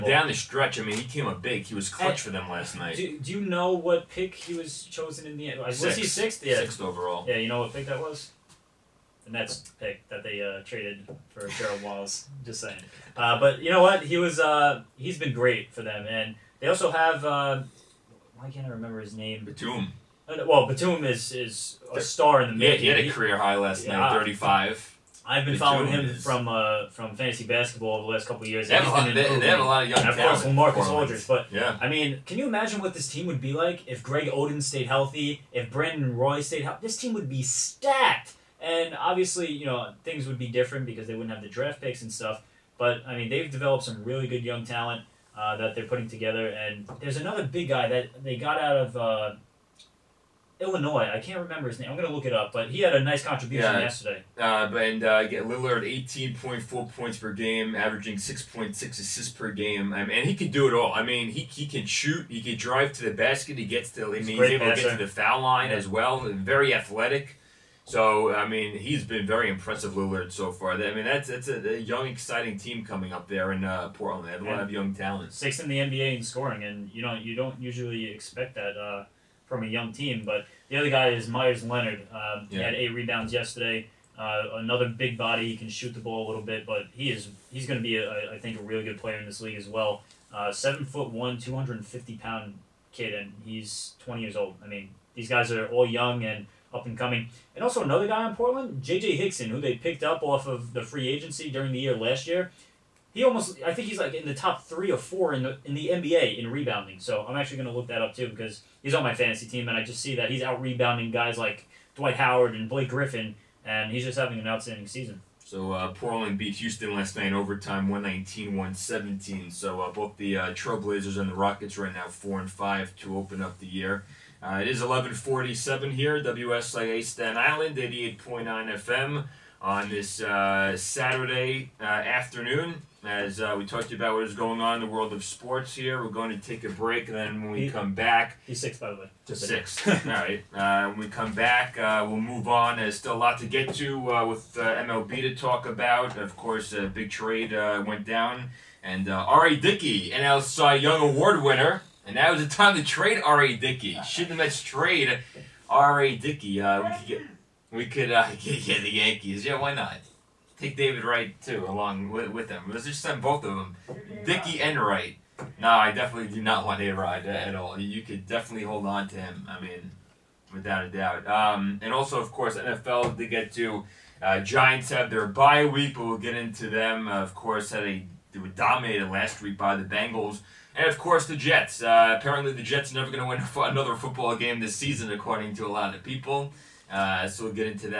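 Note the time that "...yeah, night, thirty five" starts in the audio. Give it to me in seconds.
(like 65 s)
23 s.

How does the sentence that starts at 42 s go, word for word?
But I mean, they've developed some really good young talent uh, that they're putting together.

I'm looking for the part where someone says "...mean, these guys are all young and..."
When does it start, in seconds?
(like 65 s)
94 s.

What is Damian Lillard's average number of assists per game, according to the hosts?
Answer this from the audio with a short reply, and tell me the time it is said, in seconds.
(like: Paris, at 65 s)
6.6, at 58 s.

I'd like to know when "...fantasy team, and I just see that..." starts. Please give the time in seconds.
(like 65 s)
109 s.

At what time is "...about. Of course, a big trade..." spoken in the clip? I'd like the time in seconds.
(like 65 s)
145 s.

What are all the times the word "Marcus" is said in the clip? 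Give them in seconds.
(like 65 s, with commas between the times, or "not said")
30 s.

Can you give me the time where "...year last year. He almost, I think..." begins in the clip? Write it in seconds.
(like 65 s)
101 s.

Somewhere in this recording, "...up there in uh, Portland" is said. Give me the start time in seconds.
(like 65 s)
73 s.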